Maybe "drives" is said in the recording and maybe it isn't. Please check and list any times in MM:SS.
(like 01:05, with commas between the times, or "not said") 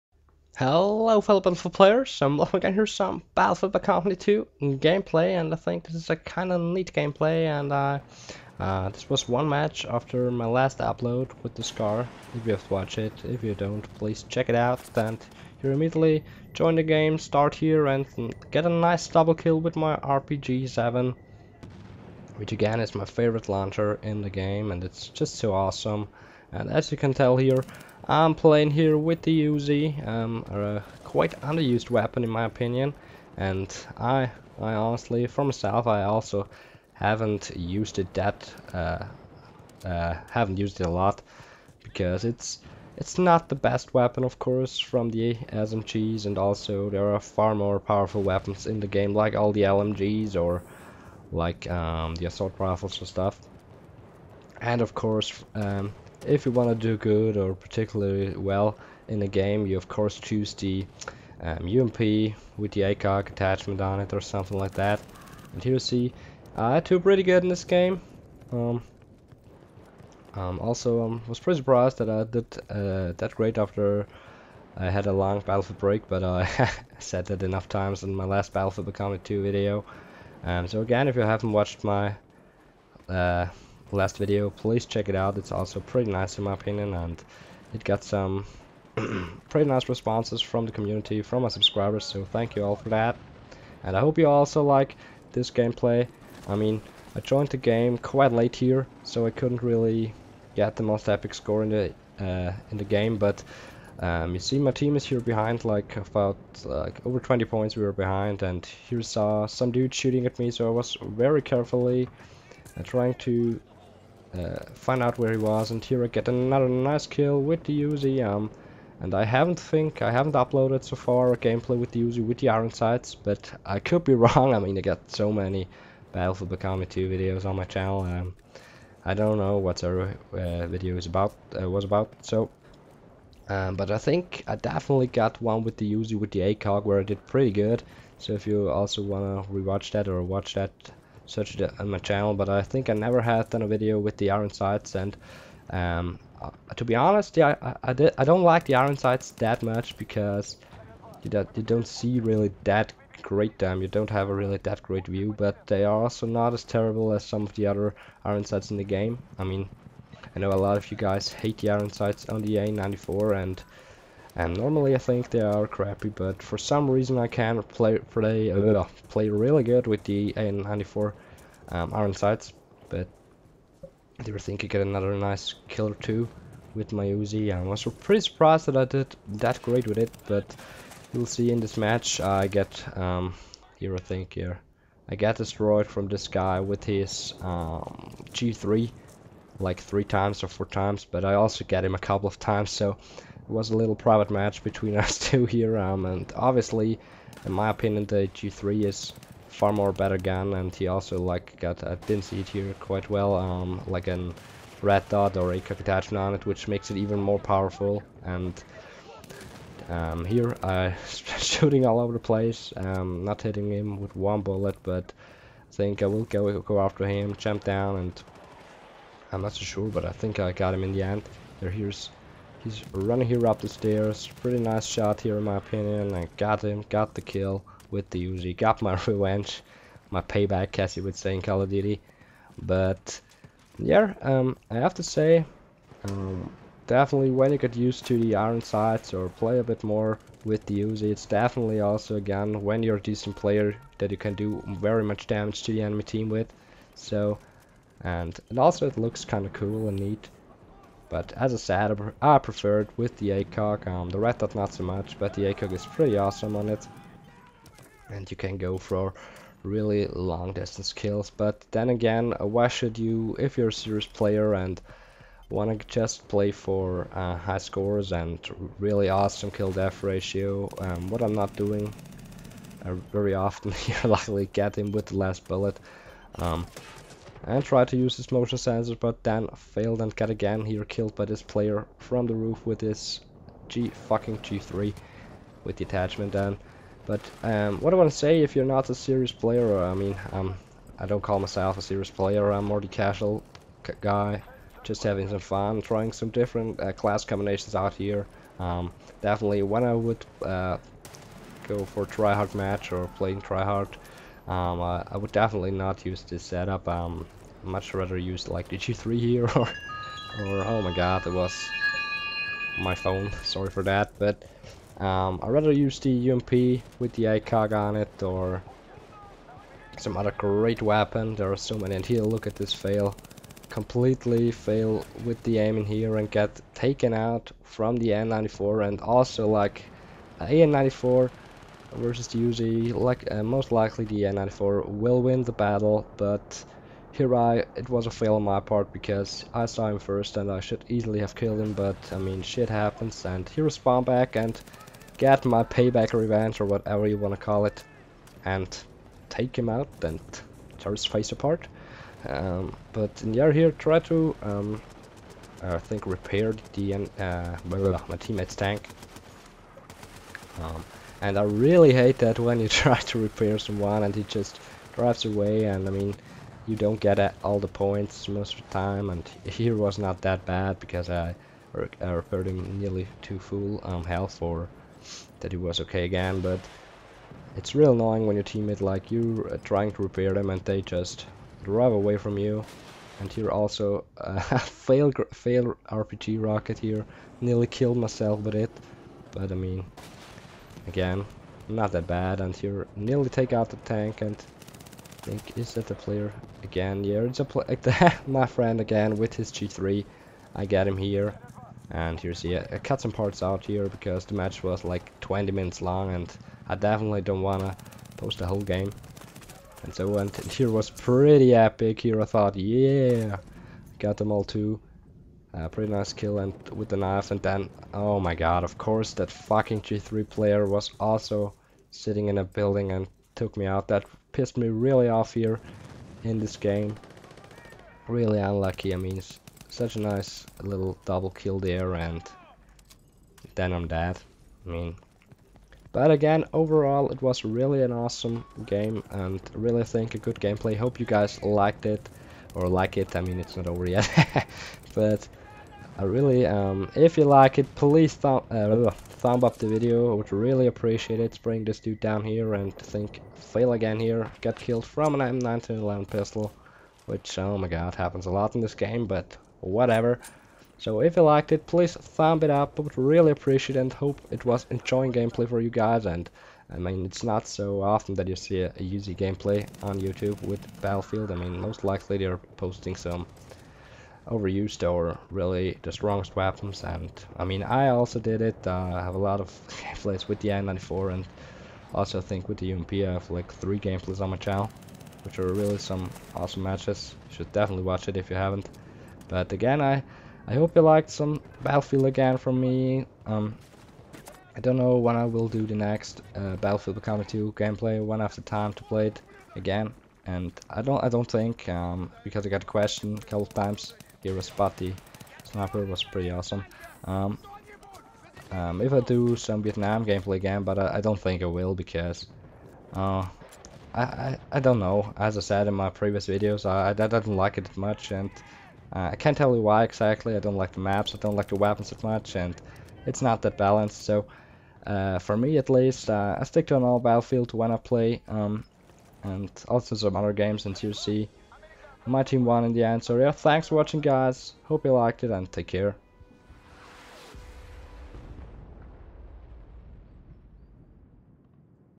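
06:04, 06:21.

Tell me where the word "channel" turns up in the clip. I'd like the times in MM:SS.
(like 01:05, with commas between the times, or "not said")
02:07, 02:21, 08:04.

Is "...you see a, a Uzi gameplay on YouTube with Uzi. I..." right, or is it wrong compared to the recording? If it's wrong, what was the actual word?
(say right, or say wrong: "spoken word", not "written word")
wrong: "Battlefield", not "Uzi".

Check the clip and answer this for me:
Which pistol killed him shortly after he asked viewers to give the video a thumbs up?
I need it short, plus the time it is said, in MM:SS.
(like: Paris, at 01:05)
M1911, at 07:35.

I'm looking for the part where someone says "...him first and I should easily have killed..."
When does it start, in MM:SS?
05:39.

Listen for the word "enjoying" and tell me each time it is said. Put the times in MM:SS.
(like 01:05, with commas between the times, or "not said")
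07:44.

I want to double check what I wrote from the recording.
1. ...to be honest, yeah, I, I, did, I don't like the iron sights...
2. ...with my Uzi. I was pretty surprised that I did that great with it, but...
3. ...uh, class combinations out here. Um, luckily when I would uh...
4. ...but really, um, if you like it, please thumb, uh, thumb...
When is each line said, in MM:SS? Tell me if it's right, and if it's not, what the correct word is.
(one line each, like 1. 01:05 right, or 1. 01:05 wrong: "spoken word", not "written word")
1. 02:26 right
2. 02:56 right
3. 04:56 wrong: "definitely", not "luckily"
4. 07:24 right.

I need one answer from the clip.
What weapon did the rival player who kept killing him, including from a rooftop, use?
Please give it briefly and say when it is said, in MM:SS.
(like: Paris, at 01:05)
G3, at 03:08.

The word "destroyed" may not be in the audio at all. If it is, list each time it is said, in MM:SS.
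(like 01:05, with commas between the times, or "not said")
03:05.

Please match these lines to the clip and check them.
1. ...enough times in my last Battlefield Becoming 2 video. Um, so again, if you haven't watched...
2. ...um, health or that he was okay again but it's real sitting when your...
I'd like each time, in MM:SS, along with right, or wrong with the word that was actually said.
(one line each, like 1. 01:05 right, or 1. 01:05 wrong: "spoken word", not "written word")
1. 01:17 right
2. 06:13 wrong: "annoying", not "sitting".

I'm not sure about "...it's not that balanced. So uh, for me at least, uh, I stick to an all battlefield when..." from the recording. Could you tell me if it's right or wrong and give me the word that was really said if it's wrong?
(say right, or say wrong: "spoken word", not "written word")
right.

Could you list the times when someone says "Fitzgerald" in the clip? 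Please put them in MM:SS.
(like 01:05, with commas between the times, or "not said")
not said.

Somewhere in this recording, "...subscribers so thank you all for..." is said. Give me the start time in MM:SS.
01:31.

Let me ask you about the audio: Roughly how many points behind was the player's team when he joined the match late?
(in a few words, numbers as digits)
over 20.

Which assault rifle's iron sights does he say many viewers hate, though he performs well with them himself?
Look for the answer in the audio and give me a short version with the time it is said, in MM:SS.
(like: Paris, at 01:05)
AN94, at 02:50.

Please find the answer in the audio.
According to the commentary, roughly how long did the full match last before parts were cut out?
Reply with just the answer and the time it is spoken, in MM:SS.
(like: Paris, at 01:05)
20 minutes, at 06:45.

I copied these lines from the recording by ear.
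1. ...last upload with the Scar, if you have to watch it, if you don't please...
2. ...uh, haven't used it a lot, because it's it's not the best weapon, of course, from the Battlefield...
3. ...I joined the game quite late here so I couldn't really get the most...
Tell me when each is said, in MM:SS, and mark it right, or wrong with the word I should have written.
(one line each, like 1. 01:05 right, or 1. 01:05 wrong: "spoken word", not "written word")
1. 00:10 right
2. 00:39 wrong: "SMGs", not "Battlefield"
3. 01:37 right.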